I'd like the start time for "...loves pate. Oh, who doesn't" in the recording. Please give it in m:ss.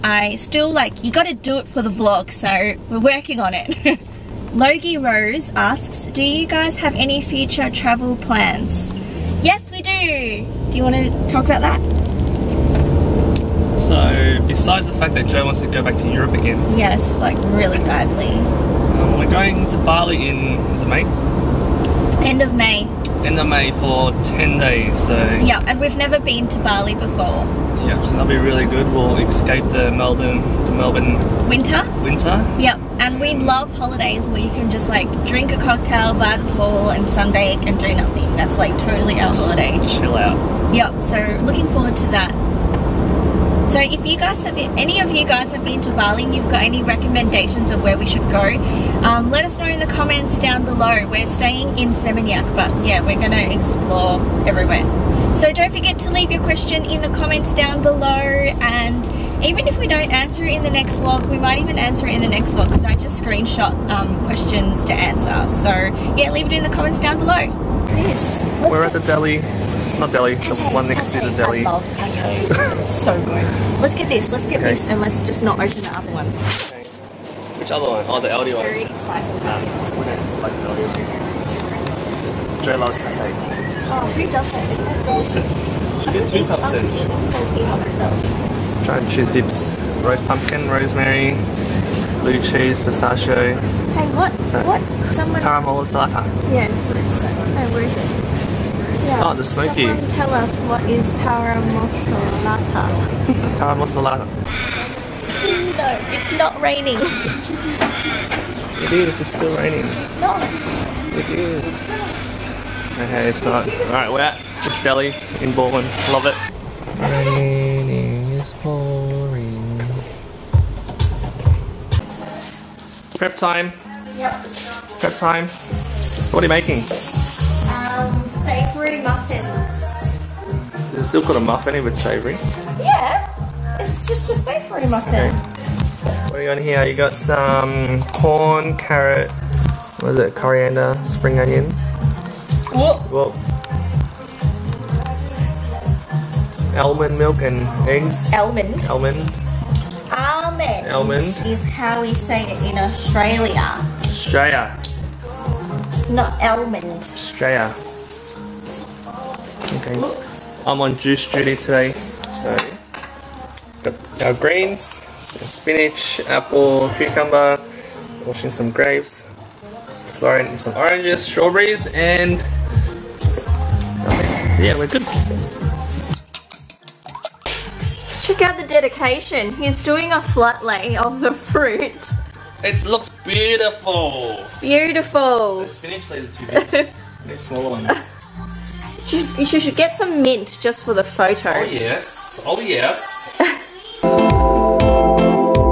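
1:22.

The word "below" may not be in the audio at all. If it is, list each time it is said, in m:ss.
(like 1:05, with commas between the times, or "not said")
0:50, 0:57, 1:07.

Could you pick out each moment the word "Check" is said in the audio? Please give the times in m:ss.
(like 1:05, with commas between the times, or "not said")
2:58.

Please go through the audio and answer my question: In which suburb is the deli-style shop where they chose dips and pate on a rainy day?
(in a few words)
Balwyn.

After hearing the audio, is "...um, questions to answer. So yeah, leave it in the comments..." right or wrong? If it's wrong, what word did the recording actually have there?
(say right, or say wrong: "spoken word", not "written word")
right.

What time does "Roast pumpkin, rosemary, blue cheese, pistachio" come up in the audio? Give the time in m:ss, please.
1:30.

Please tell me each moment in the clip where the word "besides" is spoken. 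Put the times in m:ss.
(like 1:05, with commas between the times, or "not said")
0:14.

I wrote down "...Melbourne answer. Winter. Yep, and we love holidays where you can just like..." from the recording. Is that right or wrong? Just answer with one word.
wrong.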